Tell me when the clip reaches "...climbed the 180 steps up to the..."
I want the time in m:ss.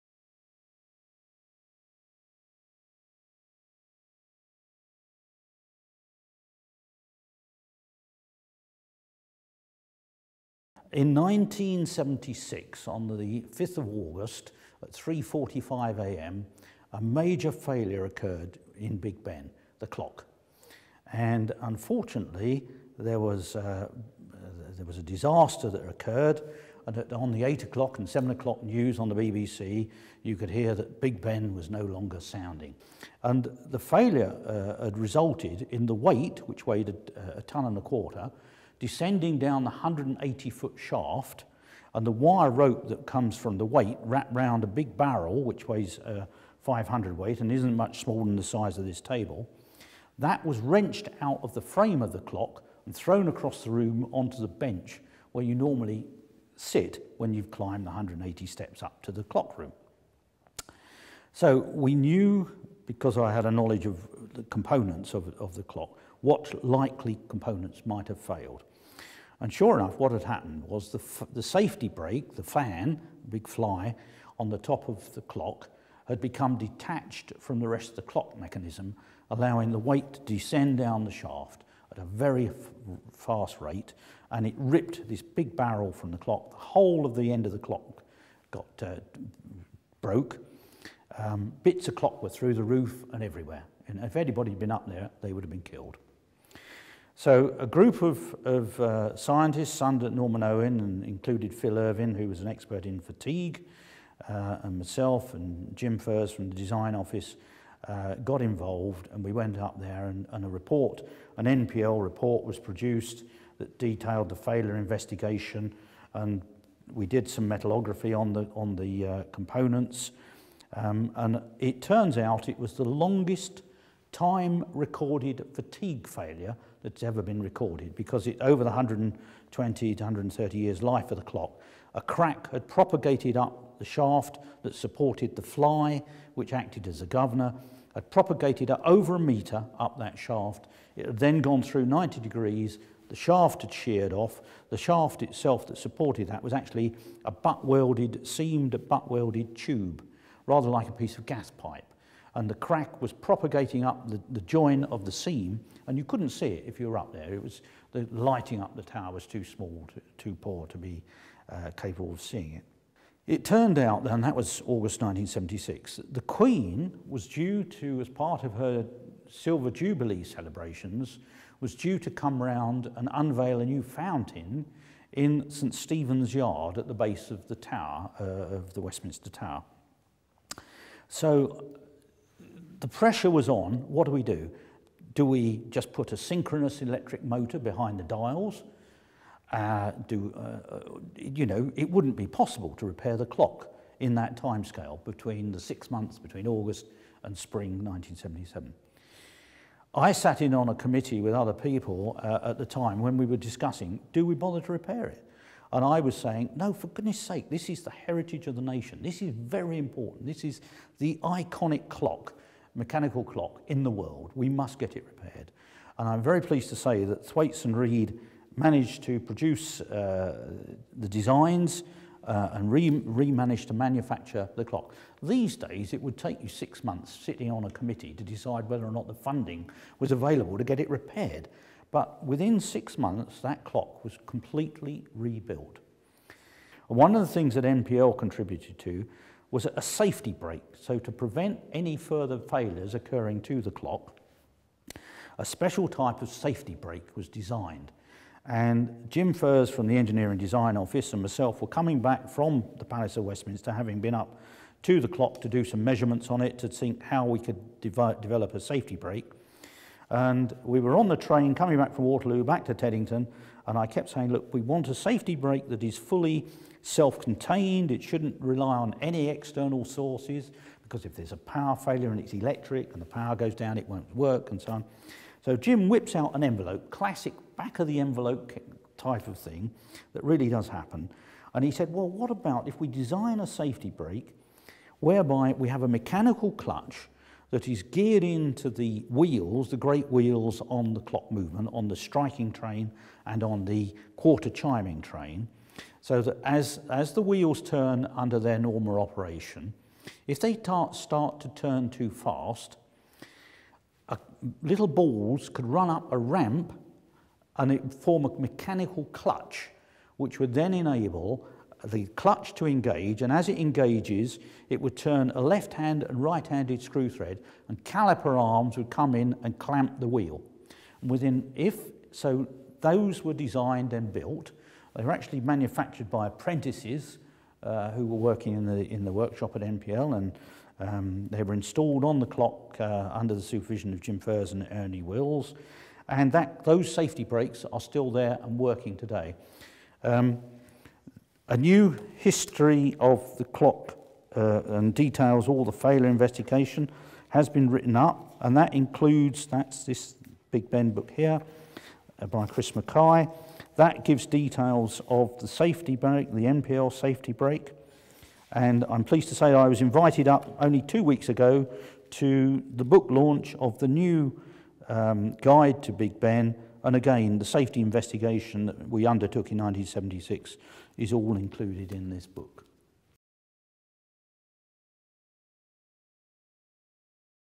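0:57.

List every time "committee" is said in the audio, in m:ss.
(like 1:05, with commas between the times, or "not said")
3:20, 3:47.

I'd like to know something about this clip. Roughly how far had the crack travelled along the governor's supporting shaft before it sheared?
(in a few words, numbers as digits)
over a metre.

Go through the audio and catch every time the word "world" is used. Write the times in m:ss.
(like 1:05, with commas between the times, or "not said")
3:33.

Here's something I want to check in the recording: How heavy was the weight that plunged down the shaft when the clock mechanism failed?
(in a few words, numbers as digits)
a ton and a quarter.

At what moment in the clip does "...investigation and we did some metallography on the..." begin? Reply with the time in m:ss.
1:54.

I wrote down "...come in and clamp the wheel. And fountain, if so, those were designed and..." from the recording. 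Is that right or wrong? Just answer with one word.
wrong.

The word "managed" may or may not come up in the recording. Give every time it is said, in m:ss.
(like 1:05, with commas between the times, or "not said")
3:38, 3:43.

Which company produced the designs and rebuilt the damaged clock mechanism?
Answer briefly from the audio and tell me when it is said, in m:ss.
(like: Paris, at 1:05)
Thwaites and Reed, at 3:37.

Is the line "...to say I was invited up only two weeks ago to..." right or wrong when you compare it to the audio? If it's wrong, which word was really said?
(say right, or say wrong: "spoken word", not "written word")
right.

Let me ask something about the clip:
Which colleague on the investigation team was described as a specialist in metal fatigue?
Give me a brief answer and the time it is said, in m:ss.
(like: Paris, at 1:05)
Phil Irvin, at 1:41.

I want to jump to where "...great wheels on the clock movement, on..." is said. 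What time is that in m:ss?
4:49.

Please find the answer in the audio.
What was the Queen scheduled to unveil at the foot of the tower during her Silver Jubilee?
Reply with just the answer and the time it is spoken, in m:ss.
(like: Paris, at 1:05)
a new fountain, at 2:53.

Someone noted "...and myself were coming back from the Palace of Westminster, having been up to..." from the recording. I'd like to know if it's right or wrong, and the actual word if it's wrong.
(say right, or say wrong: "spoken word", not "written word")
right.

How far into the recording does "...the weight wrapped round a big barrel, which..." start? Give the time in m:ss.
0:43.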